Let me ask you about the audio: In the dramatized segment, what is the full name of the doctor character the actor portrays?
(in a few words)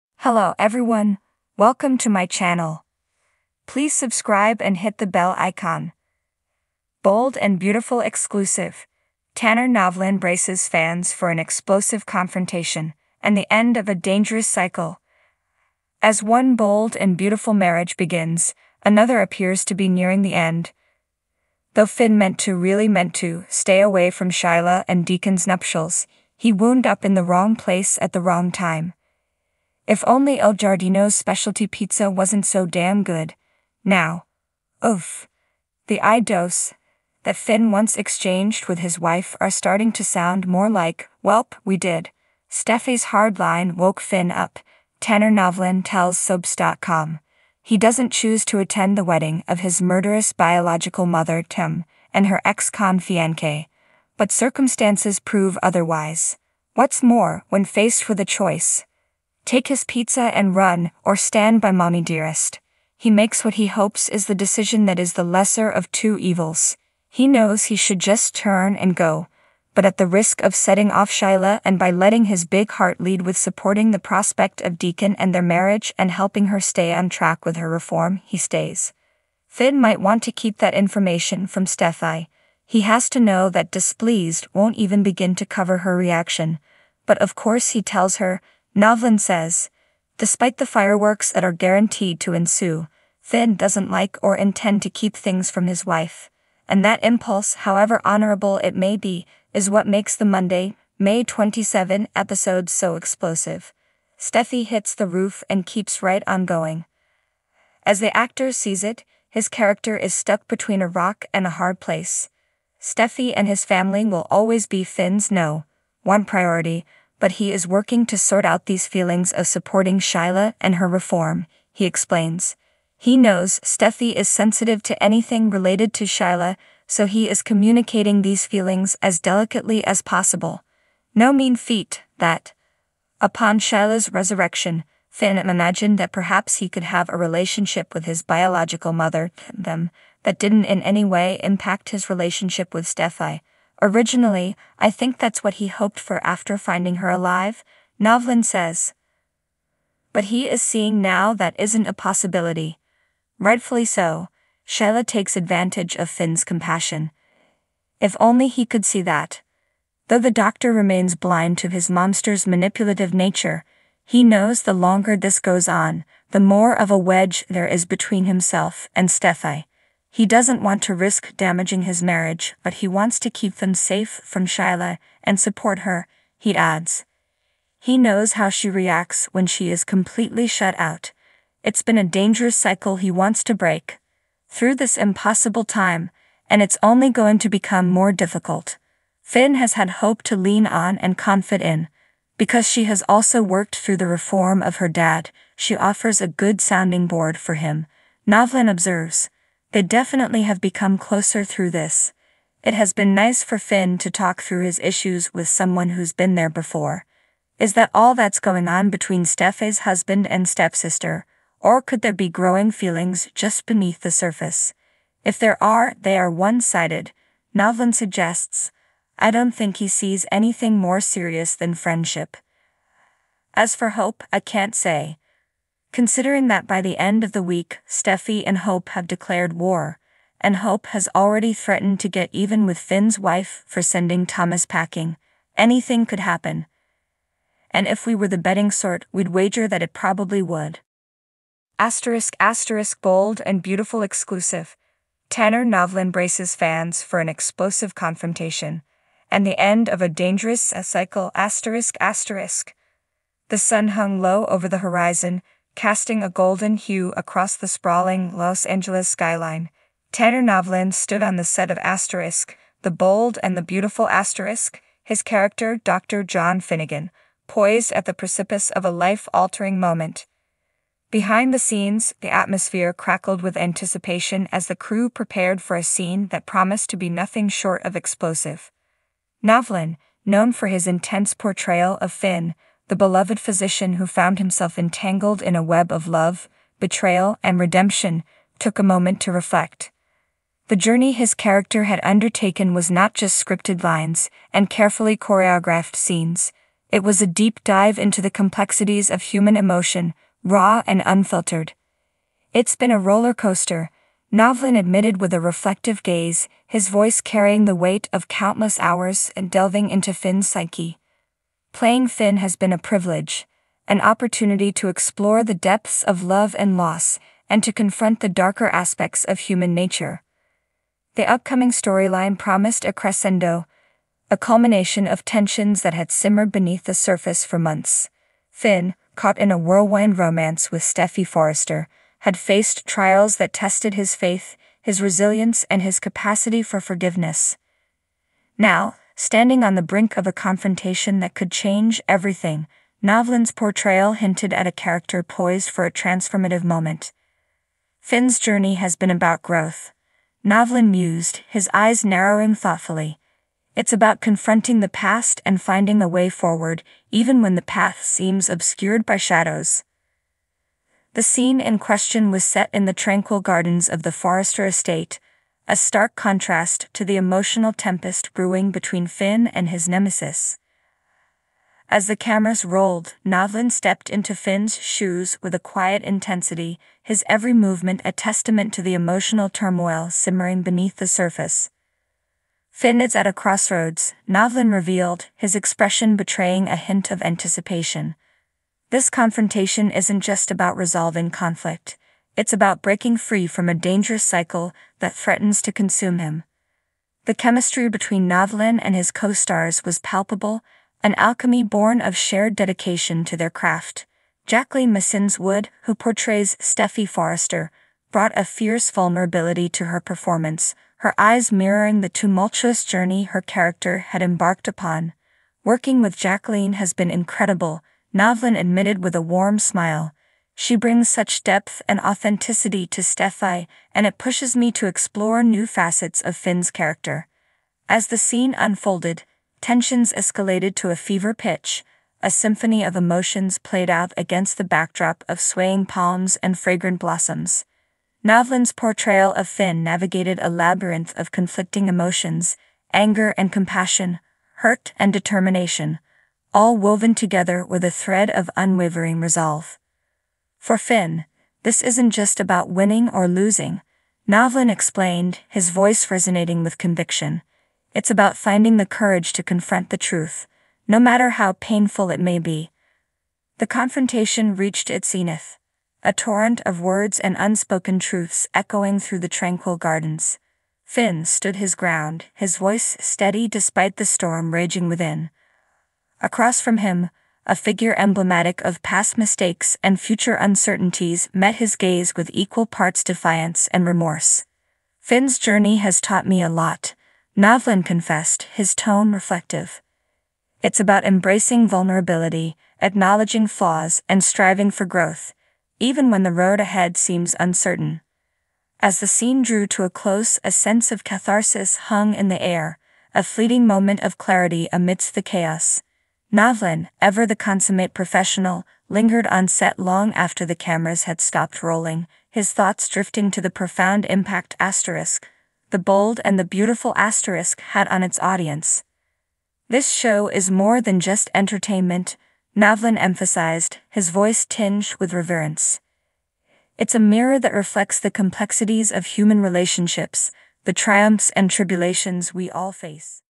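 Dr. John Finnegan.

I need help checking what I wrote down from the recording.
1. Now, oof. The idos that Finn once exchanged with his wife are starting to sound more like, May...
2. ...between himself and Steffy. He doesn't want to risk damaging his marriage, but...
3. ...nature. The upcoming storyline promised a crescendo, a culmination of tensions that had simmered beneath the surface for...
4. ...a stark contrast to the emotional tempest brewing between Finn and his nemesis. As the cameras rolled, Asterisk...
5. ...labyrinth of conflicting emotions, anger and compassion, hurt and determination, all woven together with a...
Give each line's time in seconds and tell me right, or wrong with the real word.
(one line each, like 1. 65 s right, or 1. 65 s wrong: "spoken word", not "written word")
1. 33 s wrong: "Welp", not "May"
2. 167 s right
3. 319 s right
4. 365 s wrong: "Novlan", not "Asterisk"
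5. 440 s right.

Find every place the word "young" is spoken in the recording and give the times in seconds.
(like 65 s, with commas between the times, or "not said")
not said.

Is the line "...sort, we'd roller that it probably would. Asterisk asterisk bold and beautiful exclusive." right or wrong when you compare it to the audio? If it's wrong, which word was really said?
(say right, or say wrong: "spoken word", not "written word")
wrong: "wager", not "roller".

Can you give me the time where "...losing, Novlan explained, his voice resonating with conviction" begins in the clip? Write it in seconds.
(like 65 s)
453 s.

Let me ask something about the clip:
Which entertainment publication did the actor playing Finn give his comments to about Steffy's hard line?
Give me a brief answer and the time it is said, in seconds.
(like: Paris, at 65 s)
Soaps.com, at 46 s.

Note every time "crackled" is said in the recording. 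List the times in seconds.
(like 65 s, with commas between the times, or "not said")
272 s.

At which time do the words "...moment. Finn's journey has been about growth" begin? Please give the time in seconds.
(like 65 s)
346 s.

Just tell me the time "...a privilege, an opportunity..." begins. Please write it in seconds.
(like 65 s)
312 s.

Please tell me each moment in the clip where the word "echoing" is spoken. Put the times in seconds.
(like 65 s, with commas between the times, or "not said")
468 s.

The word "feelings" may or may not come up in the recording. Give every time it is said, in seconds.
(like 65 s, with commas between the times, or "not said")
118 s, 128 s, 212 s.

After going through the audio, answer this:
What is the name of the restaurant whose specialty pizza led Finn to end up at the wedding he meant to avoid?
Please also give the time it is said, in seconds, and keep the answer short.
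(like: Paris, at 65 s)
El Giardino, at 30 s.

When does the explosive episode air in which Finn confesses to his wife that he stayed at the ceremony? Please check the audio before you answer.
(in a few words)
Monday, May 27.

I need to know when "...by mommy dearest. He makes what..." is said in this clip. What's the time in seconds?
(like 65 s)
61 s.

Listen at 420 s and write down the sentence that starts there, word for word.
She brings such depth and authenticity to Steffy, and it pushes me to explore new facets of Finn's character.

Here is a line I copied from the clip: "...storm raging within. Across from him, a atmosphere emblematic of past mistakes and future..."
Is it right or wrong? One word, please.
wrong.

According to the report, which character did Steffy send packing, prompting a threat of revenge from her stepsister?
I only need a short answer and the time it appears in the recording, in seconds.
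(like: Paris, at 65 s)
Thomas, at 234 s.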